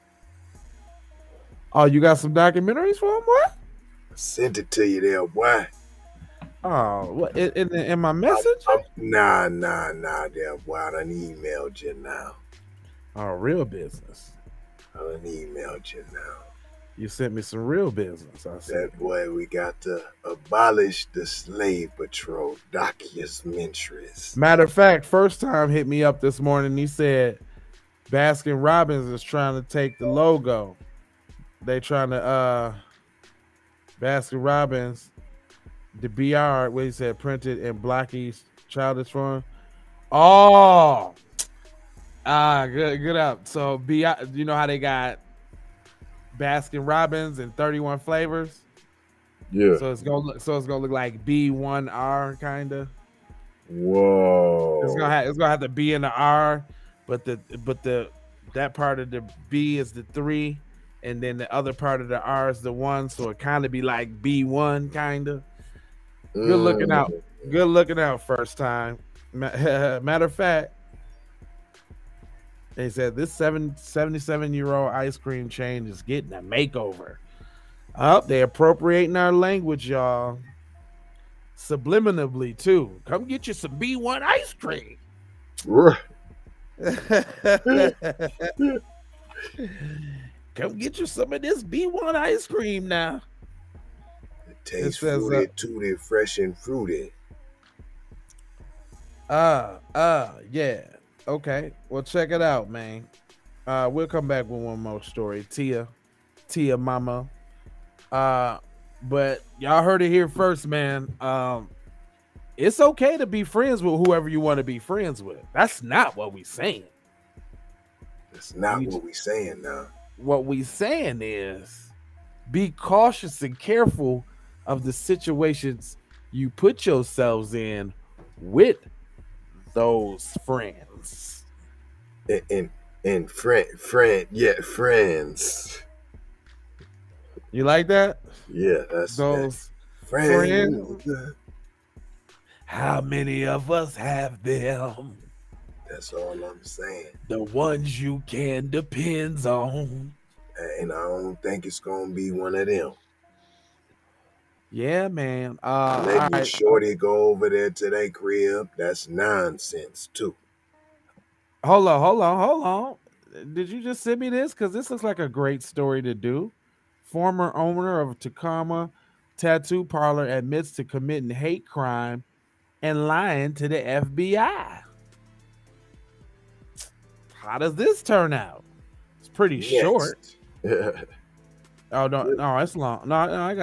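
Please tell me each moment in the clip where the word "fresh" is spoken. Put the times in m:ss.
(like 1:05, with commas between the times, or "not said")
1:35.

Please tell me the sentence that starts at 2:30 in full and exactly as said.
And I don't think it's gonna be one of them.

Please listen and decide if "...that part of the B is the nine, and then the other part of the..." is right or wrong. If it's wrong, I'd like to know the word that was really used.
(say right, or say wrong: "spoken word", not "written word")
wrong: "three", not "nine".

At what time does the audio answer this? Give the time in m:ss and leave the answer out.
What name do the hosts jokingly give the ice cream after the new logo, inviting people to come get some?
1:31.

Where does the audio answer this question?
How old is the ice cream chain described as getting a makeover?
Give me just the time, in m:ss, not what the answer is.
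1:13.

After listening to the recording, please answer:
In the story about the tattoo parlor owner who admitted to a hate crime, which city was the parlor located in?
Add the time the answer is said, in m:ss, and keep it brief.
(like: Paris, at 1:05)
Tacoma, at 2:48.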